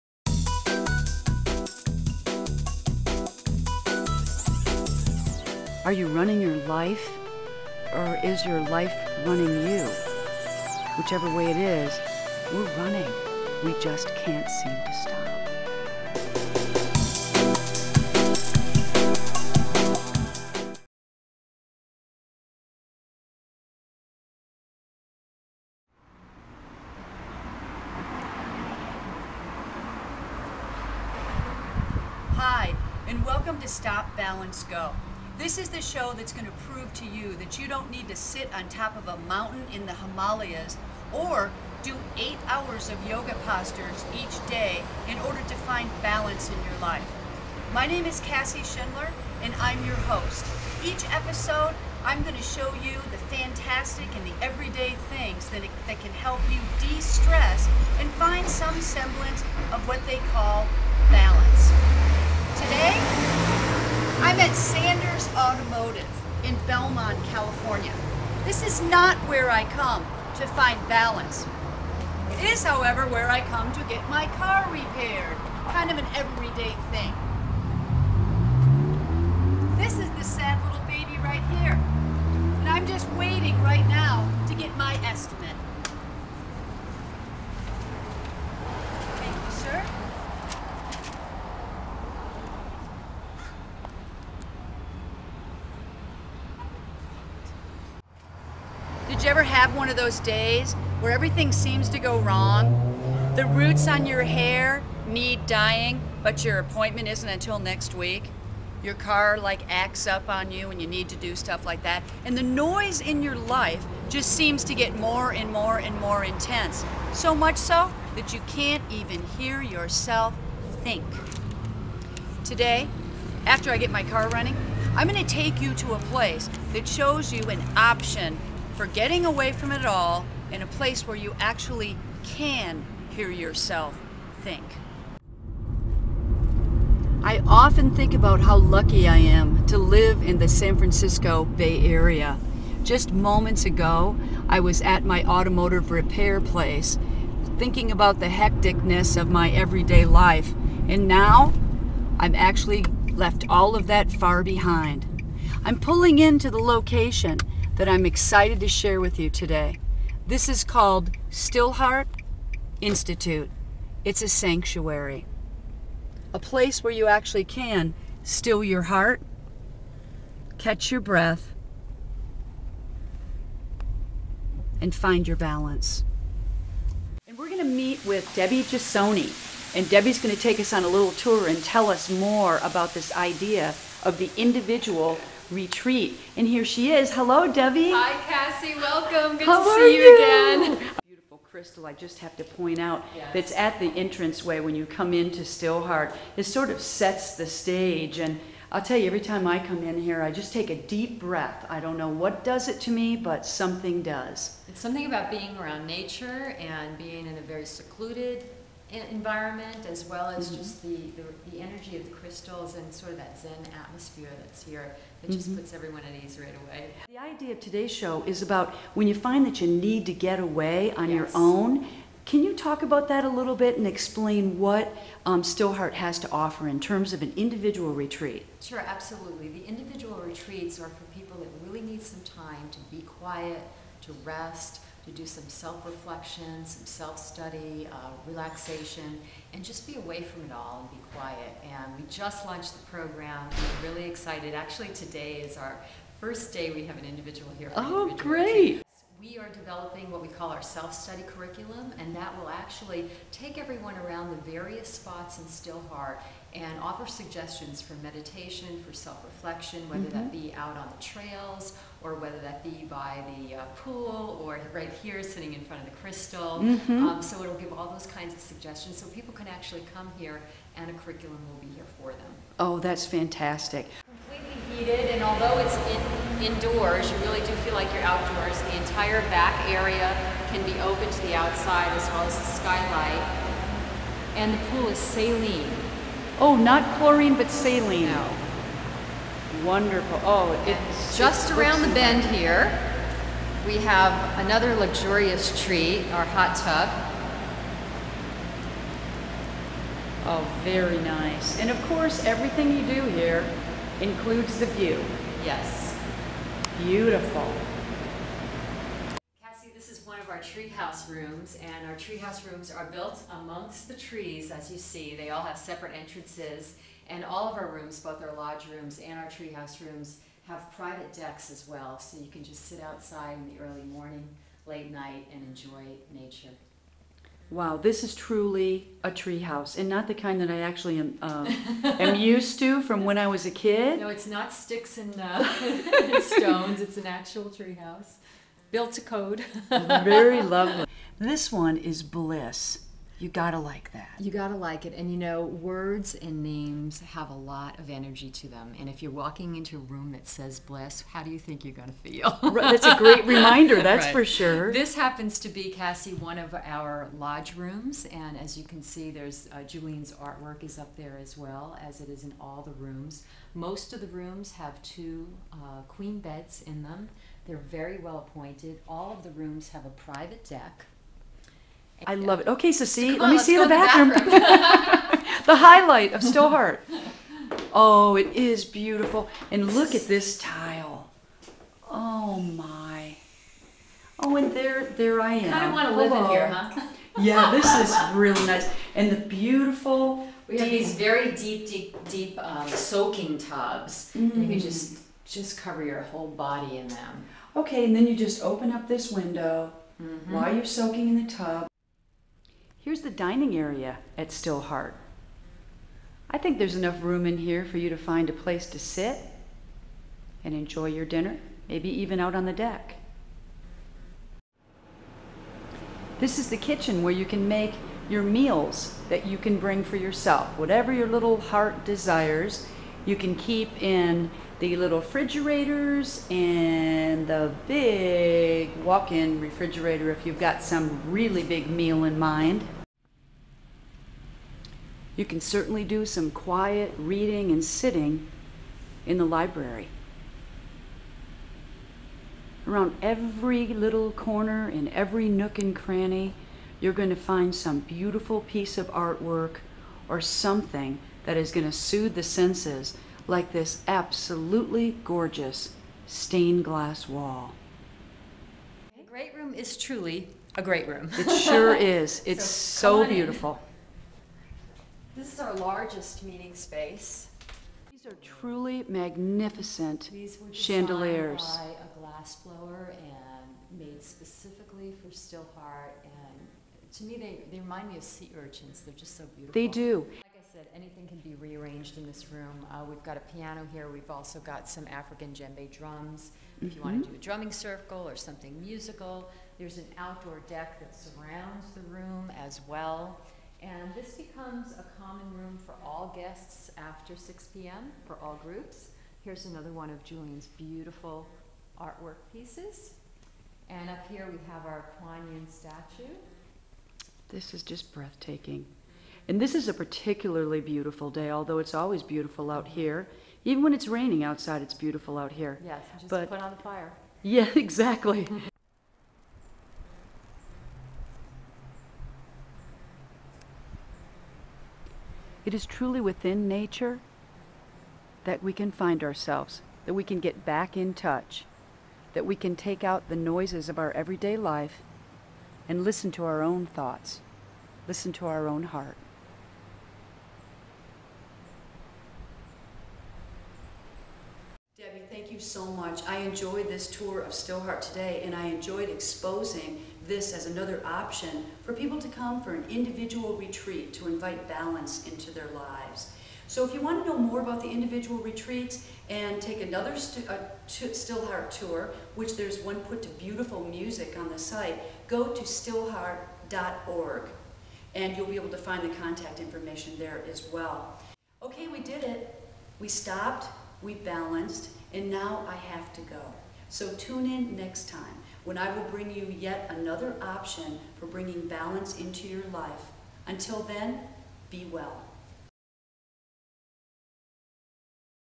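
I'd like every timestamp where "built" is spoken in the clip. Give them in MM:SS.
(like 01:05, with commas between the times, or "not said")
05:12, 05:38.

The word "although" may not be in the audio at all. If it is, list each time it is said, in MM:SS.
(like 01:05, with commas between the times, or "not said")
04:35, 08:31.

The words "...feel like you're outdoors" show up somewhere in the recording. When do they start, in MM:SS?
04:37.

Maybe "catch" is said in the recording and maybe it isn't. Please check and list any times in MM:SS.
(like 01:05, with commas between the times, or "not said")
02:50.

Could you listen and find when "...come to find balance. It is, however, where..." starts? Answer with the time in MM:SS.
01:09.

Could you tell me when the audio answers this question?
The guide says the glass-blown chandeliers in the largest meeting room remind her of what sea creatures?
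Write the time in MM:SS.
07:58.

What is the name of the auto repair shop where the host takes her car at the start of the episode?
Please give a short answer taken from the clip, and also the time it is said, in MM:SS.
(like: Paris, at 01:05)
Sanders Automotive, at 01:04.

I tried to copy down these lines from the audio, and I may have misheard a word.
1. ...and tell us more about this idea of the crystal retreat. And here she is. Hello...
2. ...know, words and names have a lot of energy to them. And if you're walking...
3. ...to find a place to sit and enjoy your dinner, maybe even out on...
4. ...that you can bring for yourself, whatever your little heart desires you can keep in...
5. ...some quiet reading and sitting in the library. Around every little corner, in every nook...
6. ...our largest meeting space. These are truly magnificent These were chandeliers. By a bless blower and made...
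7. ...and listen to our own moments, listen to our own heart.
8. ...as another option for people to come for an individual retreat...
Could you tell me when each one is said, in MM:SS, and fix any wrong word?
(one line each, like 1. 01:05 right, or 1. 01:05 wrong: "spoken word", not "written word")
1. 03:01 wrong: "individual", not "crystal"
2. 05:45 right
3. 06:47 right
4. 06:59 right
5. 07:16 right
6. 07:45 wrong: "glass", not "bless"
7. 08:55 wrong: "thoughts", not "moments"
8. 09:10 right.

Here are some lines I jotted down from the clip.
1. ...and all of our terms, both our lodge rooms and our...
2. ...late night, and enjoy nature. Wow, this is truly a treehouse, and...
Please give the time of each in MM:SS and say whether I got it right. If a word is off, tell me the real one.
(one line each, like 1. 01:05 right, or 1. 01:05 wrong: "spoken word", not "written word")
1. 05:17 wrong: "rooms", not "terms"
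2. 05:24 right.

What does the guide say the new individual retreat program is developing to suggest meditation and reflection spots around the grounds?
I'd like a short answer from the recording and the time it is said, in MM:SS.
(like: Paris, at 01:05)
self-study curriculum, at 04:10.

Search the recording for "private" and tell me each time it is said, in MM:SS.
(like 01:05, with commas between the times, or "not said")
05:20, 06:09.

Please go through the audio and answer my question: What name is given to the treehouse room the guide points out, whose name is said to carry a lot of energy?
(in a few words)
bliss.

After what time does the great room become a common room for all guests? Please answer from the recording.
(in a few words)
6 p.m.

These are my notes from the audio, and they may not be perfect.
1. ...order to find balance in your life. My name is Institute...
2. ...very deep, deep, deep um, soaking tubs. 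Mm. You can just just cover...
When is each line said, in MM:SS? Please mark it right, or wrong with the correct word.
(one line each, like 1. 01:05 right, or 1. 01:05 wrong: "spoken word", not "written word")
1. 00:45 wrong: "Cassie", not "Institute"
2. 06:30 right.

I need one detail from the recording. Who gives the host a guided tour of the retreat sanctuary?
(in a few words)
Debbie Gisonni.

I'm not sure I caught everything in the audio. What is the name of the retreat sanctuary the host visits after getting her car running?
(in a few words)
Stillheart Institute.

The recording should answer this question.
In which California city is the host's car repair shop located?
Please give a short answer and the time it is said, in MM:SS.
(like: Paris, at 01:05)
Belmont, at 01:06.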